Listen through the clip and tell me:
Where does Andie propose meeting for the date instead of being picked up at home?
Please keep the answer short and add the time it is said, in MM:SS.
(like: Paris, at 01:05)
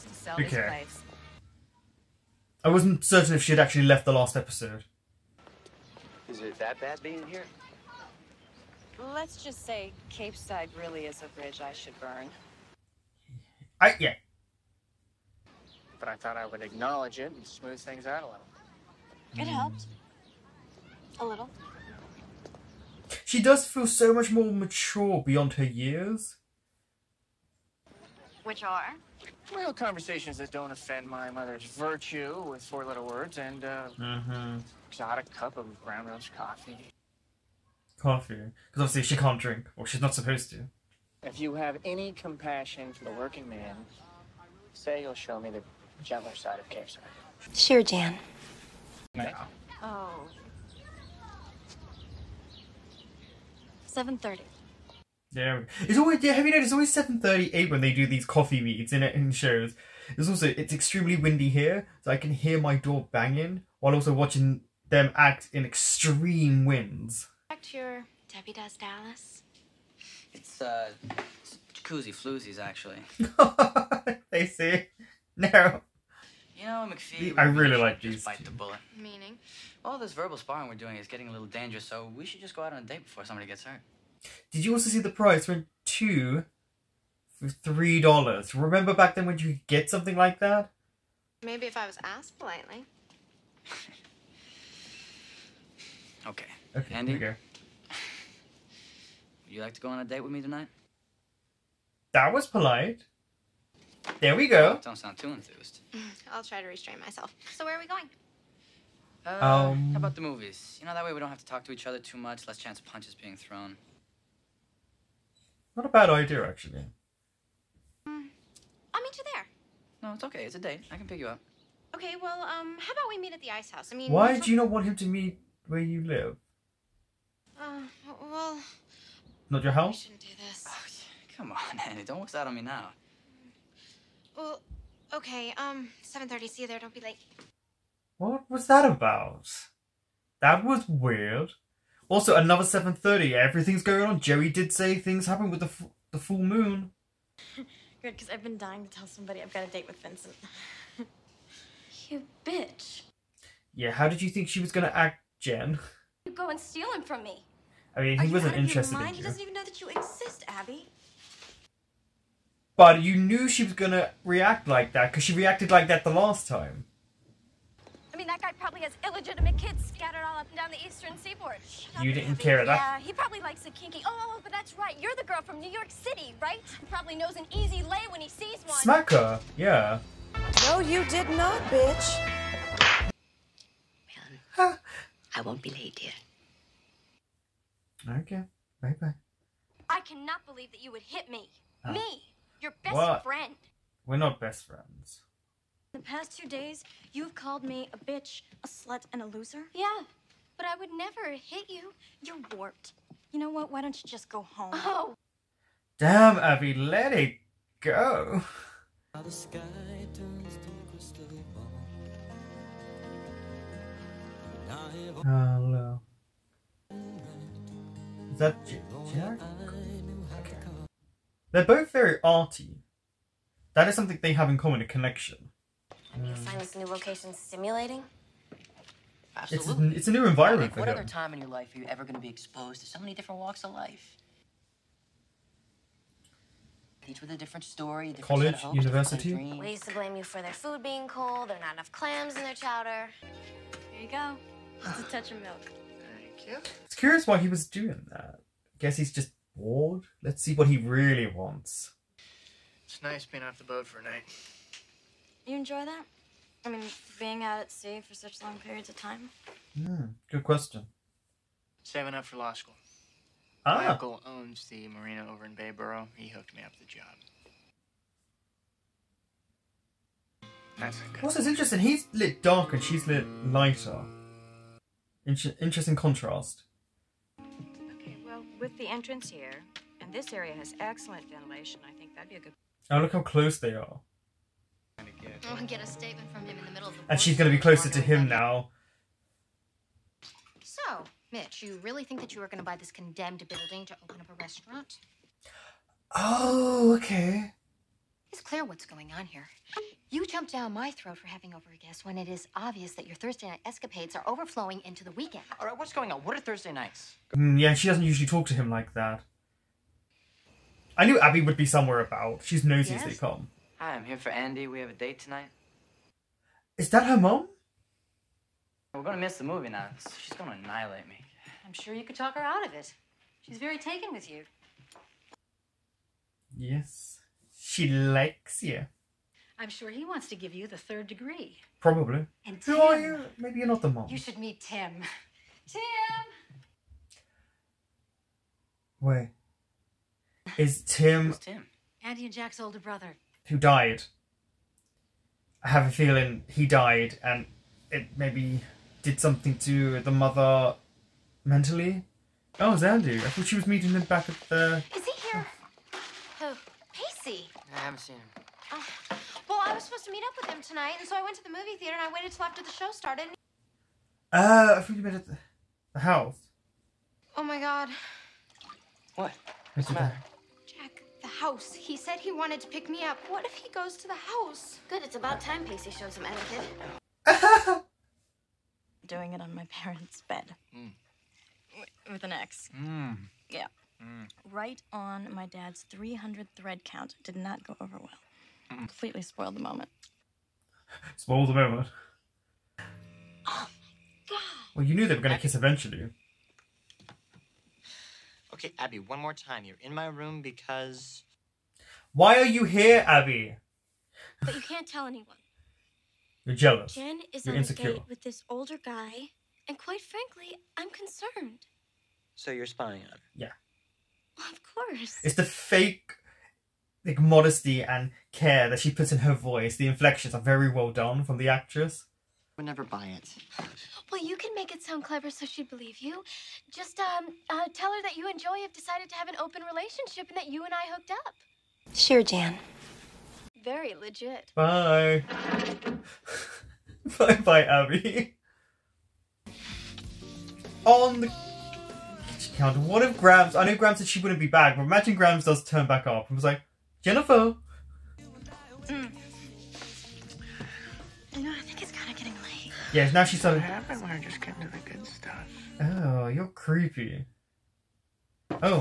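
the Ice House, at 02:03.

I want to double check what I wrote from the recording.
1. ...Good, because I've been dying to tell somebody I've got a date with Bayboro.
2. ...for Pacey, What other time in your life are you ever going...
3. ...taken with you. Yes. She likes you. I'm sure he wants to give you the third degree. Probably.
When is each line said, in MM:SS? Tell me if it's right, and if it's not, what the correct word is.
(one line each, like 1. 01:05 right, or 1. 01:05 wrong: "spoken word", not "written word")
1. 02:27 wrong: "Vincent", not "Bayboro"
2. 03:50 wrong: "Nick", not "Pacey"
3. 05:23 right.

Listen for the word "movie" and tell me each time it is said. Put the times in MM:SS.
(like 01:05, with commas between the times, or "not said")
01:50, 05:19, 06:01.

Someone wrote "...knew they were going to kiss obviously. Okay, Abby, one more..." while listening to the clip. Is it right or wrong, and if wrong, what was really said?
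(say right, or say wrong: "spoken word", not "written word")
wrong: "eventually", not "obviously".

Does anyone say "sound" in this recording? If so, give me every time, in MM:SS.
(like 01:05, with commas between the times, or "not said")
01:44, 07:04.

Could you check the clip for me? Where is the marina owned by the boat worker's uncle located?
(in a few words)
Bayboro.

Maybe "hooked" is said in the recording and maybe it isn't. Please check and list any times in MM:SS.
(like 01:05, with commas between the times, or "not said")
04:26, 07:10.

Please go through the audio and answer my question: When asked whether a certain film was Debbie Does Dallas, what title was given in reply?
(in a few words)
Jacuzzi Floozies.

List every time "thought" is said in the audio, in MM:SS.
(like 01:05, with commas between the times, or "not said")
00:16, 05:53.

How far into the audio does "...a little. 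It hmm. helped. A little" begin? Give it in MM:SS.
00:18.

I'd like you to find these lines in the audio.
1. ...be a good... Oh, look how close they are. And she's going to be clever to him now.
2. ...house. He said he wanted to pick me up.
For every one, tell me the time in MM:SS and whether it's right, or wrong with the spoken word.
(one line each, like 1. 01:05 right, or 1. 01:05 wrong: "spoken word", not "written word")
1. 04:42 wrong: "closer", not "clever"
2. 06:11 right.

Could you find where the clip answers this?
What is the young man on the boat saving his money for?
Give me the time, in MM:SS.
04:22.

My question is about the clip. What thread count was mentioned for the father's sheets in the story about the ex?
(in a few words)
300.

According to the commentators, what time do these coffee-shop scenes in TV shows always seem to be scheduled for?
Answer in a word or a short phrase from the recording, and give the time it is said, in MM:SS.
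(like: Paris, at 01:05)
7:30, at 00:56.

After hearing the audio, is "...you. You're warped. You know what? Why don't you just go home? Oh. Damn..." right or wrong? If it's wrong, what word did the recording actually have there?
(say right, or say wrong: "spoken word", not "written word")
right.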